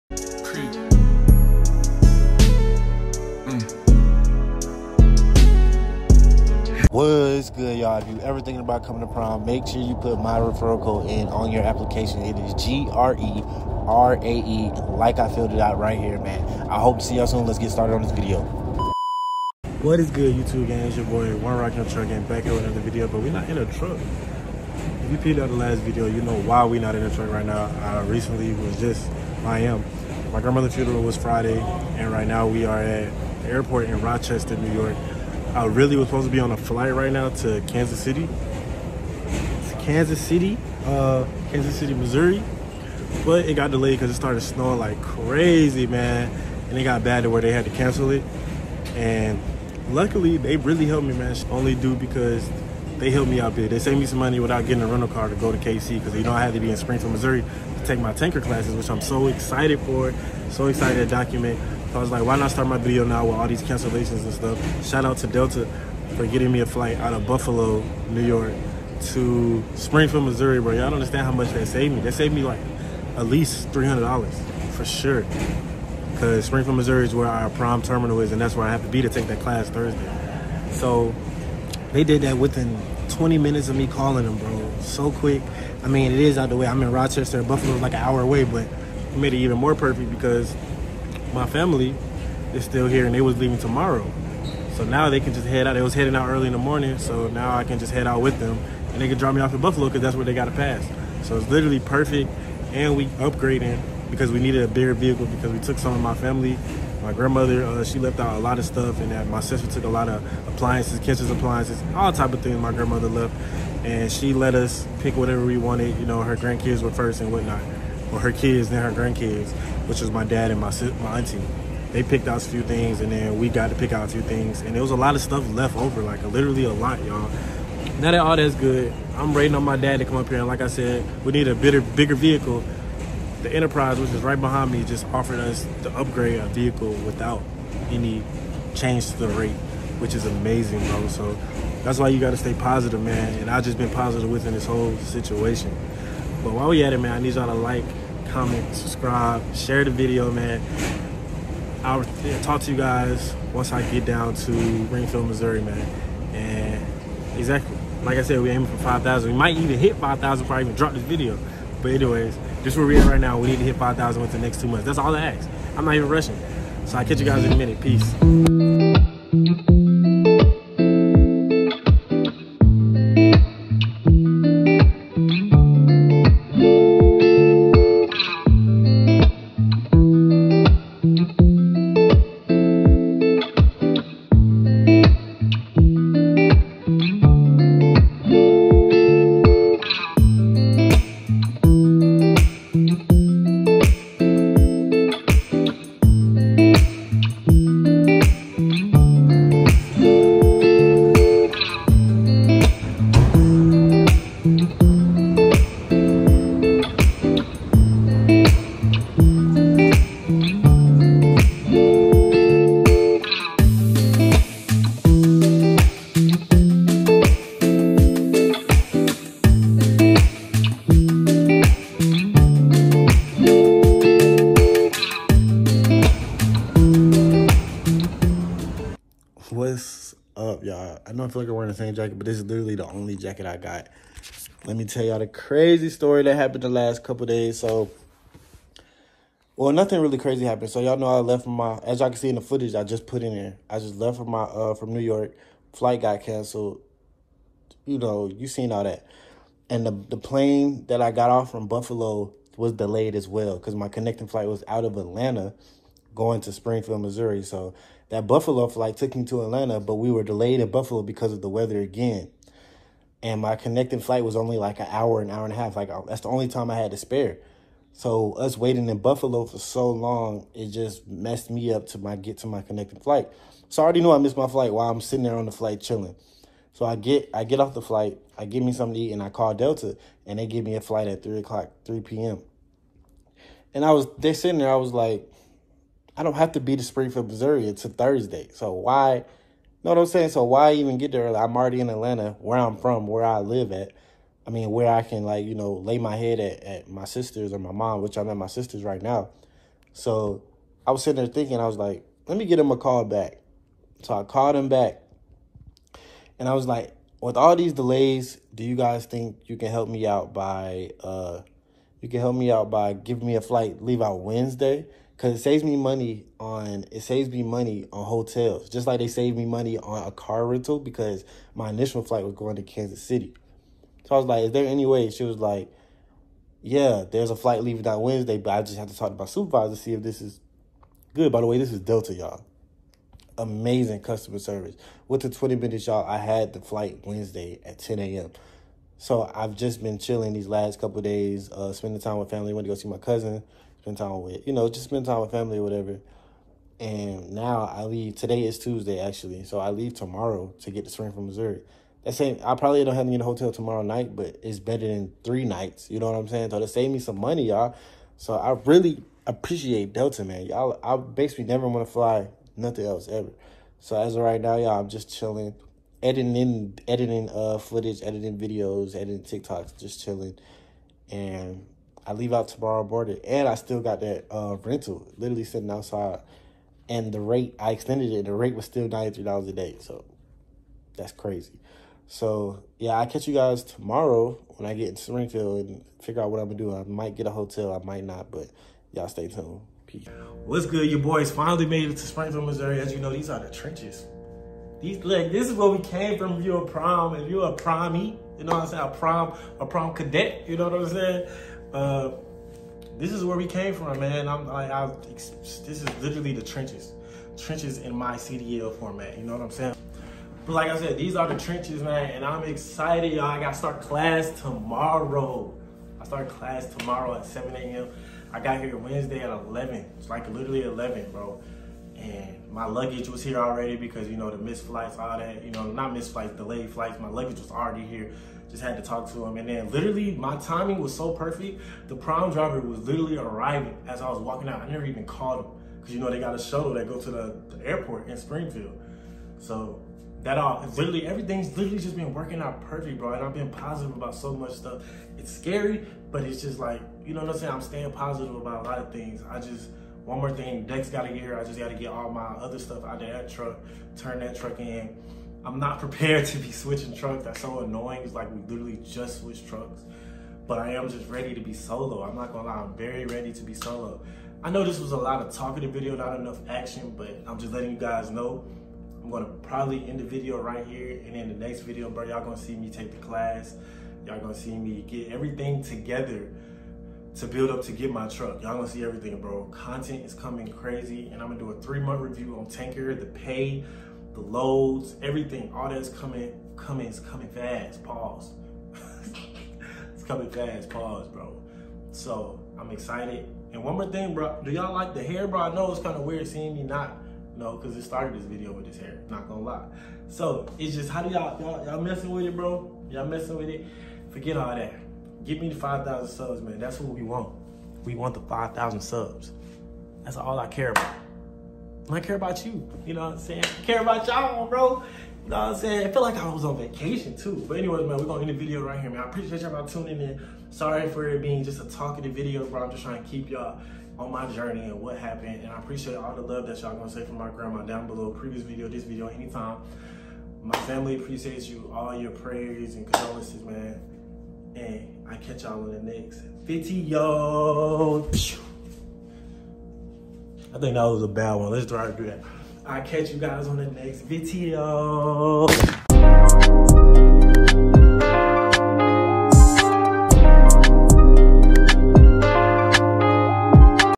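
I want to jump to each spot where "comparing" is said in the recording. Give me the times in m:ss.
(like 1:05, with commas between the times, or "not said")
not said.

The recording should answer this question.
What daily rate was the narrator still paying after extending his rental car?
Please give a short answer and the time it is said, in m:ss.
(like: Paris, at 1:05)
$93, at 6:18.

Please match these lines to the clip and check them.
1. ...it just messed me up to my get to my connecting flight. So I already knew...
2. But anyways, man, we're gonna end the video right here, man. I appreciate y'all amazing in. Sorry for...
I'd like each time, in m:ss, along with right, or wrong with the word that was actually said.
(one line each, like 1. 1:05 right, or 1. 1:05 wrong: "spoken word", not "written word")
1. 4:30 right
2. 8:37 wrong: "tuning", not "amazing".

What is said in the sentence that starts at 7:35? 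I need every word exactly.
I'm not prepared to be switching trucks.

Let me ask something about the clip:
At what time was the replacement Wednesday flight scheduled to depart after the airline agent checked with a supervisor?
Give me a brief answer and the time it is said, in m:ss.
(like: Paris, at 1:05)
10 a.m., at 5:37.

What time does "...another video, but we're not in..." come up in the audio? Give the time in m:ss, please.
0:22.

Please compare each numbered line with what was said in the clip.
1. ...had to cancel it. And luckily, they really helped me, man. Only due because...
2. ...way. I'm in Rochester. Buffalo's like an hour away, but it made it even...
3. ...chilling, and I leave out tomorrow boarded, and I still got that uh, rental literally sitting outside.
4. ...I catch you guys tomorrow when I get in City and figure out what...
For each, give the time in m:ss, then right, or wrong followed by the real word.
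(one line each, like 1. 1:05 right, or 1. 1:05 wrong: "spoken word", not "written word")
1. 0:47 right
2. 1:26 right
3. 6:10 right
4. 6:22 wrong: "Springfield", not "City".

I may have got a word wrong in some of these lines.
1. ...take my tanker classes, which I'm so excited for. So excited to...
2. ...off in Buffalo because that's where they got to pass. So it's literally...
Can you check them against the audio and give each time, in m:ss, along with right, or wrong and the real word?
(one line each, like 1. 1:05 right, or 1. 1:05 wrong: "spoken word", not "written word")
1. 0:57 right
2. 1:39 right.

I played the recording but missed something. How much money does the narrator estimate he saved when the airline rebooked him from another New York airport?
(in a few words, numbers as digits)
$300.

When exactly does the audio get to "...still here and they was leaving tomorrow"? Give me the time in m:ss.
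1:32.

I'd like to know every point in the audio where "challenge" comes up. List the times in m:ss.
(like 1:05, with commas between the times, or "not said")
not said.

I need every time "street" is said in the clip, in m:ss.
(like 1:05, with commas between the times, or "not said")
not said.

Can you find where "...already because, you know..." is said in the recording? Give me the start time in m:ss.
7:03.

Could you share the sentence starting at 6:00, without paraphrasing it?
Y'all, I basically never want to fly nothing else ever.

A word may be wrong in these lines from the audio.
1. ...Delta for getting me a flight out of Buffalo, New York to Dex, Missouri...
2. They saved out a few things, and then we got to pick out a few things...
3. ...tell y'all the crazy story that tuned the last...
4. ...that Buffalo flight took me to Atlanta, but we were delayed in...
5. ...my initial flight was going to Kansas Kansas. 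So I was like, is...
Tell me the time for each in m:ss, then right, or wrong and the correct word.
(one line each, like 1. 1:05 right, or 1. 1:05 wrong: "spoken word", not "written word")
1. 1:05 wrong: "Springfield", not "Dex"
2. 2:01 wrong: "picked", not "saved"
3. 3:54 wrong: "happened", not "tuned"
4. 4:18 right
5. 5:21 wrong: "City", not "Kansas".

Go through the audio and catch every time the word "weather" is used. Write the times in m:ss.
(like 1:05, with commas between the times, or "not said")
4:21.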